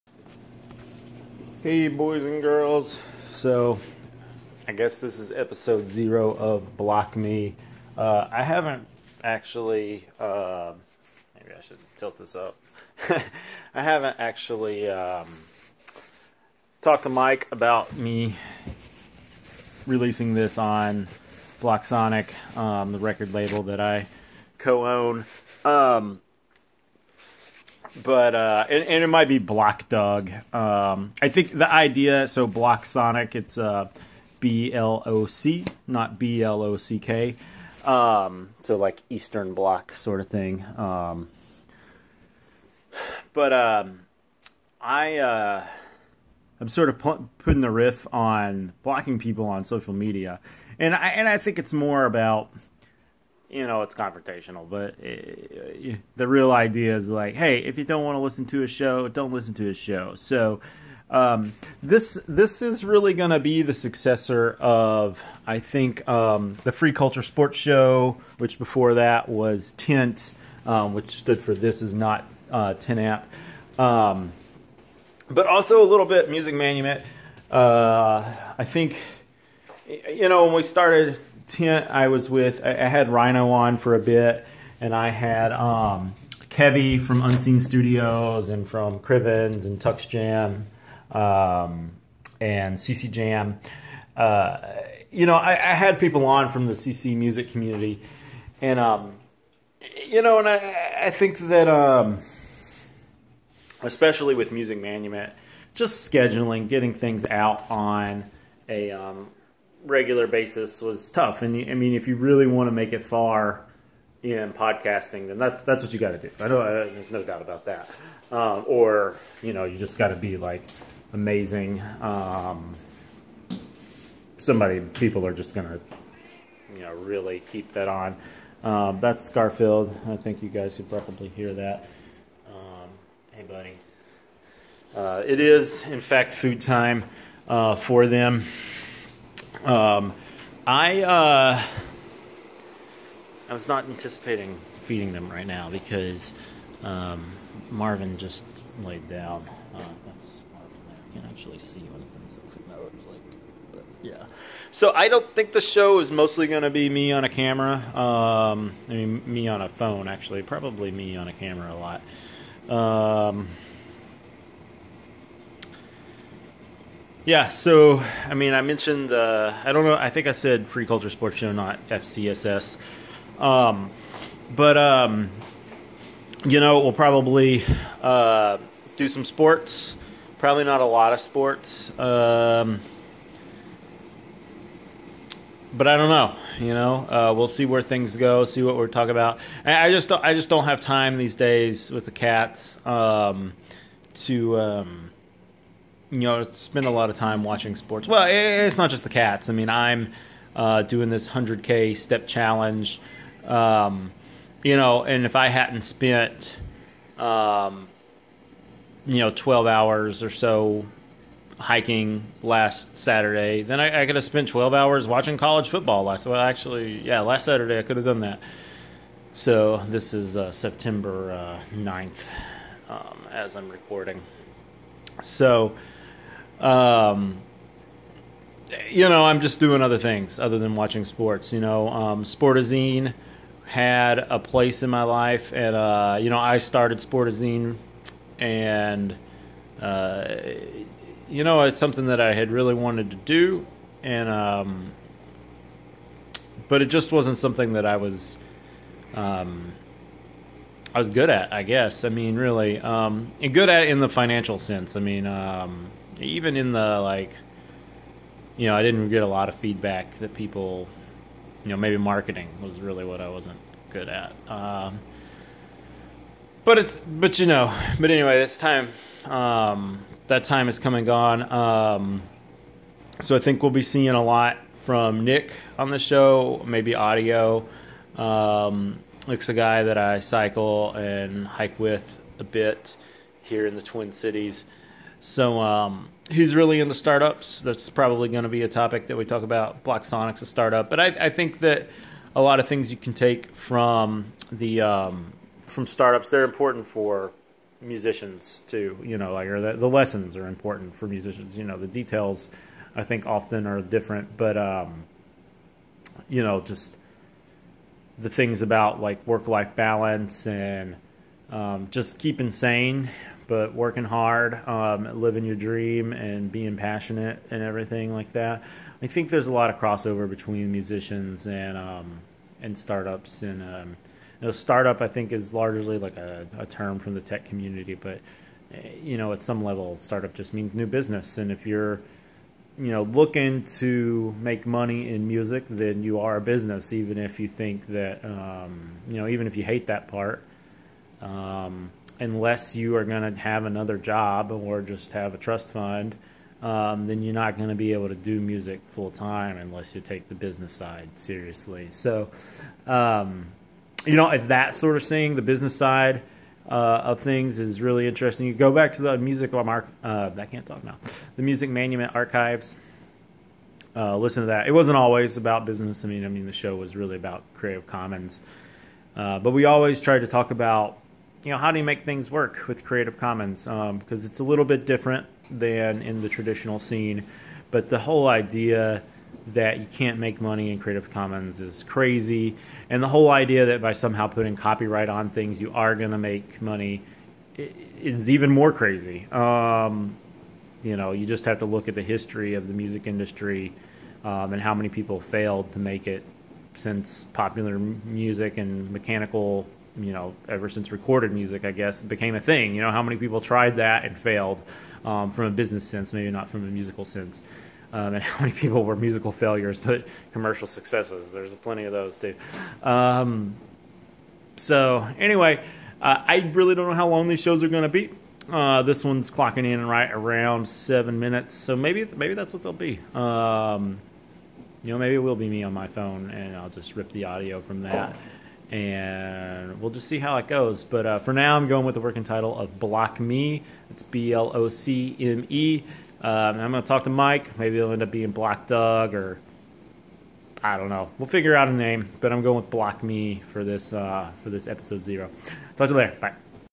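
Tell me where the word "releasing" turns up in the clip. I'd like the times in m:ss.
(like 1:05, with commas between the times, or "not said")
0:19.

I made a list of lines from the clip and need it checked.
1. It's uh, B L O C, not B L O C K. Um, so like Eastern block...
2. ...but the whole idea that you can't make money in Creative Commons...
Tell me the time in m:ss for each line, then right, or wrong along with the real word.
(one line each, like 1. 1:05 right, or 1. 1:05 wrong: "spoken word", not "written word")
1. 0:33 right
2. 6:17 right.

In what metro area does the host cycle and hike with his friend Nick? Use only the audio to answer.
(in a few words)
Twin Cities.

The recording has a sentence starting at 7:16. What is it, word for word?
Um, I'm going to talk to Mike.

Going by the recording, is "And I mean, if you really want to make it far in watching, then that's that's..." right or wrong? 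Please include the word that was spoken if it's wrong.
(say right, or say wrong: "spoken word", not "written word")
wrong: "podcasting", not "watching".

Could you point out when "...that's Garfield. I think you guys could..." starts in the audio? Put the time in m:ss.
2:08.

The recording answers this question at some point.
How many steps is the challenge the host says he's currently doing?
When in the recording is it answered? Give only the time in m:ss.
3:21.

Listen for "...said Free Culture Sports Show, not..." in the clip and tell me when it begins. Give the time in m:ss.
2:50.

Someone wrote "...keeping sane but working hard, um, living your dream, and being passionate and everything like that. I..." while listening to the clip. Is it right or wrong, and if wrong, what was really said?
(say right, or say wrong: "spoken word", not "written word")
right.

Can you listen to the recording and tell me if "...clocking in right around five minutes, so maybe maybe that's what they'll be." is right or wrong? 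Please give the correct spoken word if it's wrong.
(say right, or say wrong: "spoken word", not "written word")
wrong: "seven", not "five".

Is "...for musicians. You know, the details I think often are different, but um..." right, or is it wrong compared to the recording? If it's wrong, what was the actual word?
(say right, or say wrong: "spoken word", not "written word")
right.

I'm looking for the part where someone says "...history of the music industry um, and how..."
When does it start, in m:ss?
6:32.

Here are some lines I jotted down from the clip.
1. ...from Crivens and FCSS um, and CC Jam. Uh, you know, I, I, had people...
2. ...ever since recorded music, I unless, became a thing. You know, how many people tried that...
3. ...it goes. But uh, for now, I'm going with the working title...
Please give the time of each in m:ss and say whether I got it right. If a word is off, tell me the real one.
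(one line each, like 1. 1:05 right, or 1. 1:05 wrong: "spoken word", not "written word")
1. 1:28 wrong: "TuxJam", not "FCSS"
2. 6:40 wrong: "guess", not "unless"
3. 7:10 right.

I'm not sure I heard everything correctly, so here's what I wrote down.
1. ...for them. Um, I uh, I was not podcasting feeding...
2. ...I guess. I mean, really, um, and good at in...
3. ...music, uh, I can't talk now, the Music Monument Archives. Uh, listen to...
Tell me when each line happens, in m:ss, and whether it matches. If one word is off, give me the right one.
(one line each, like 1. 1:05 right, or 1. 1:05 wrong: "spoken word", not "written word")
1. 2:17 wrong: "anticipating", not "podcasting"
2. 4:11 right
3. 5:59 right.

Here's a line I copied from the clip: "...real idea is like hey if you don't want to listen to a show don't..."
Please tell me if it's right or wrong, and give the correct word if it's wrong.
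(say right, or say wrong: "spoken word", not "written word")
right.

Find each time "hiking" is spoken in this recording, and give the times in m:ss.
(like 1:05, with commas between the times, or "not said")
3:31.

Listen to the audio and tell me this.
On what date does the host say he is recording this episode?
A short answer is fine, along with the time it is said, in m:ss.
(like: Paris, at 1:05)
September 9th, at 3:40.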